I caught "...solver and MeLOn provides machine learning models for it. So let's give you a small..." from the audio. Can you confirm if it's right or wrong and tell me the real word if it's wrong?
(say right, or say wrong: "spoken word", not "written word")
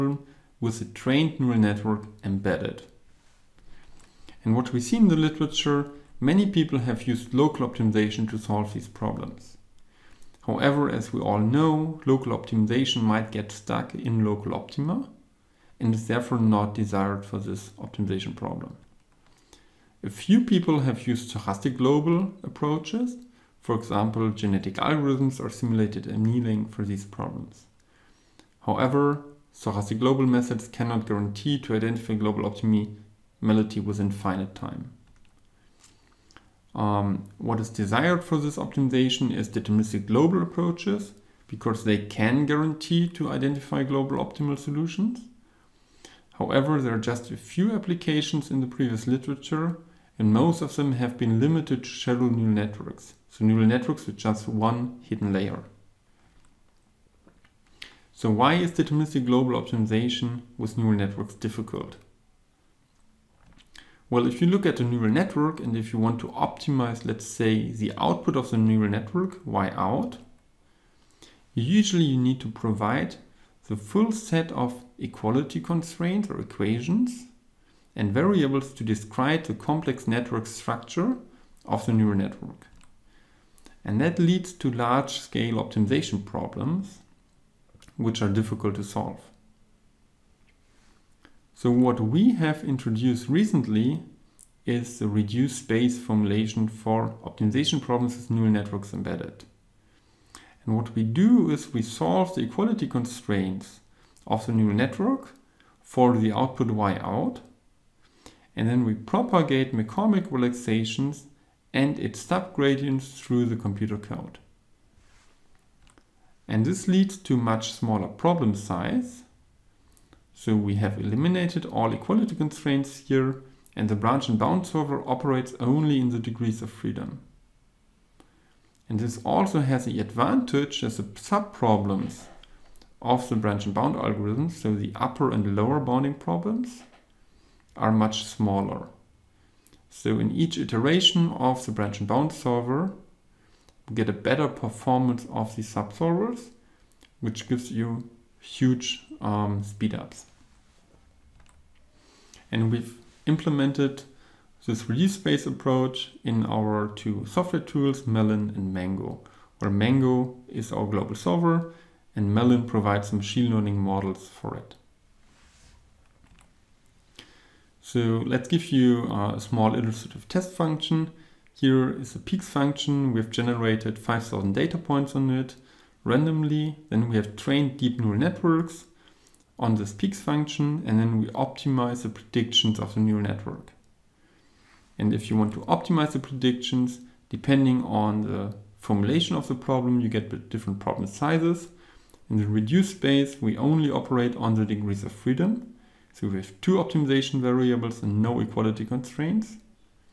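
right.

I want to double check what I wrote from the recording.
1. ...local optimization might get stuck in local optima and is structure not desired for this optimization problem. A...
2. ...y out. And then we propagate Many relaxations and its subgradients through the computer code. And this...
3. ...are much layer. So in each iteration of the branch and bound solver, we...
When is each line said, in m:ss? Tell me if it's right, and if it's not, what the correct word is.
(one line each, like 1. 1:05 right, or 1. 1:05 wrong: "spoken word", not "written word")
1. 0:12 wrong: "therefore", not "structure"
2. 1:46 wrong: "McCormick", not "Many"
3. 2:17 wrong: "smaller", not "layer".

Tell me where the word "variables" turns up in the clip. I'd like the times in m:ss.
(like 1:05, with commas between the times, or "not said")
1:18, 3:17.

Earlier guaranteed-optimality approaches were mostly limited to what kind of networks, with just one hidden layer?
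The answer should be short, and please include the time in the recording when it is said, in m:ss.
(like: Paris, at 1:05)
Shallow neural networks, at 0:51.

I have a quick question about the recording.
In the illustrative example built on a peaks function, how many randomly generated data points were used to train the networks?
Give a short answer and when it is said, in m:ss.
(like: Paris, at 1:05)
5,000, at 2:53.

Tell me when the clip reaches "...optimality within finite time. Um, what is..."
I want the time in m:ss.
0:32.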